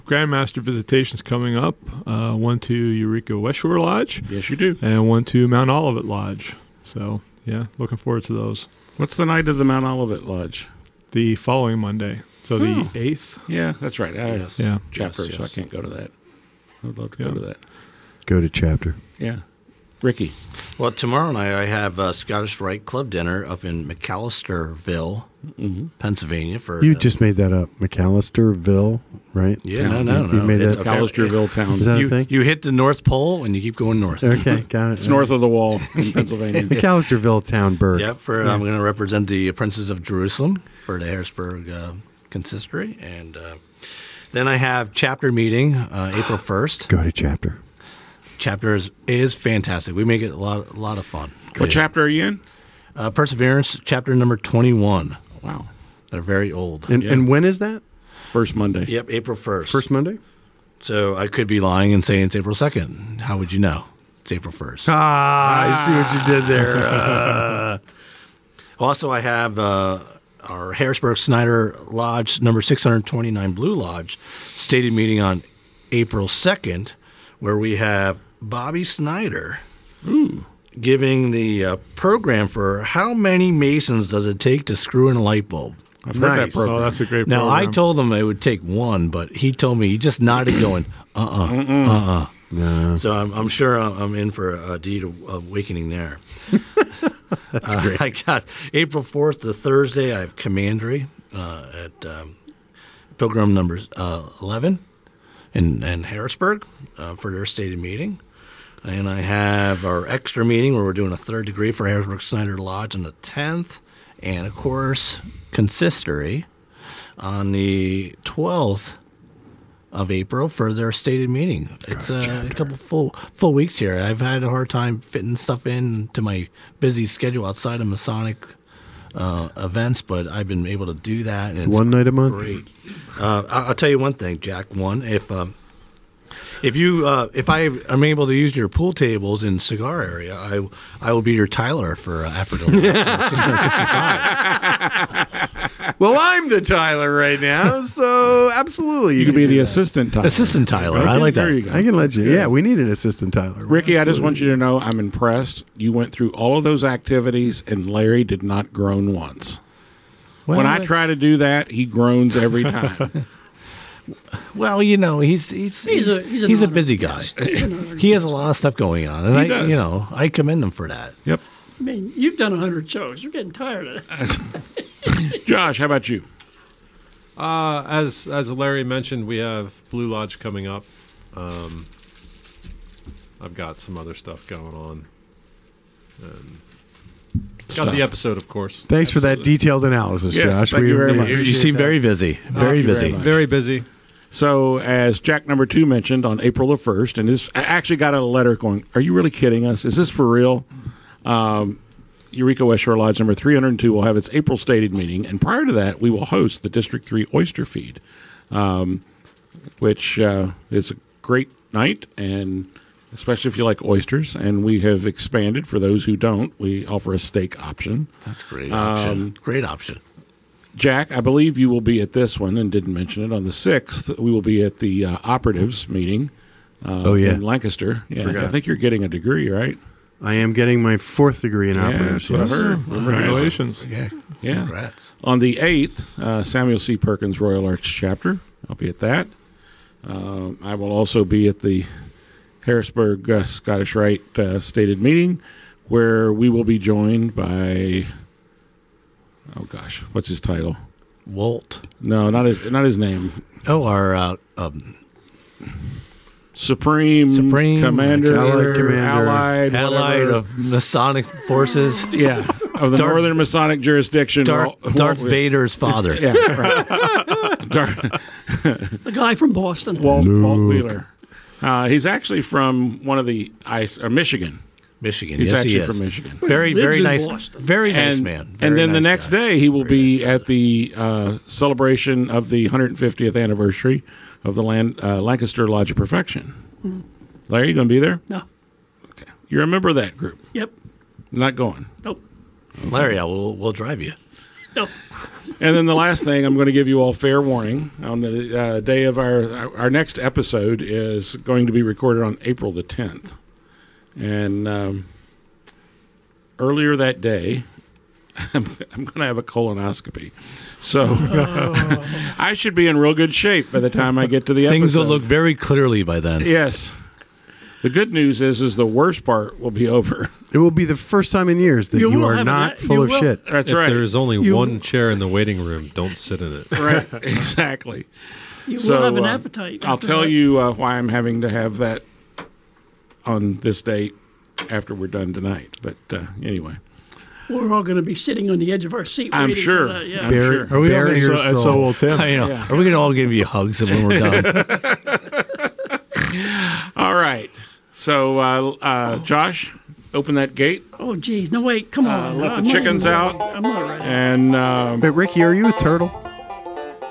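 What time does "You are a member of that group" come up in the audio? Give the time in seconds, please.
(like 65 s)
289 s.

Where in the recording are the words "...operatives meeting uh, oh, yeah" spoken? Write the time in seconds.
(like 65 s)
225 s.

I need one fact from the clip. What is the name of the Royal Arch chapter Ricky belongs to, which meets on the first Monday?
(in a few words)
Perseverance.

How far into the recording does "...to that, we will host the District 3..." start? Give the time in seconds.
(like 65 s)
205 s.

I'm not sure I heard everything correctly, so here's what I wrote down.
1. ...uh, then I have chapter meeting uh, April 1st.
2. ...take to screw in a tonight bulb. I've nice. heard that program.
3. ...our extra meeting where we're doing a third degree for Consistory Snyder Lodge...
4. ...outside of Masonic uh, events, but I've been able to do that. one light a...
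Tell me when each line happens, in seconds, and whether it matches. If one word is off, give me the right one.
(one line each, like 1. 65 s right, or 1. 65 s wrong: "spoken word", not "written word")
1. 43 s right
2. 84 s wrong: "light", not "tonight"
3. 109 s wrong: "Harrisburg", not "Consistory"
4. 127 s wrong: "night", not "light".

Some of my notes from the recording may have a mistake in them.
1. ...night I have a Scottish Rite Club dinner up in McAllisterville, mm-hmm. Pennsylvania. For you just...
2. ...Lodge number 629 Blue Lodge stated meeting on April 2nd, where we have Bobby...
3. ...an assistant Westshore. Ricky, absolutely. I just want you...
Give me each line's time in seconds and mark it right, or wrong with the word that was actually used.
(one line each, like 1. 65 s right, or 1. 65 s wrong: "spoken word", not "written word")
1. 21 s right
2. 71 s right
3. 152 s wrong: "Tyler", not "Westshore".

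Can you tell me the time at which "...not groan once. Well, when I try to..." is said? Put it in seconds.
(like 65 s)
158 s.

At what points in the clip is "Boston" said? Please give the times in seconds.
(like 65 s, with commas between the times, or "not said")
269 s, 277 s.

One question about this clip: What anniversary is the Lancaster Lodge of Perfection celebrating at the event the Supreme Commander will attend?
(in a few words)
150th.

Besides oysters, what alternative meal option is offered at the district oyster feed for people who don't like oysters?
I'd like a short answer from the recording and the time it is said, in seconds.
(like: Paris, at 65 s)
Steak, at 217 s.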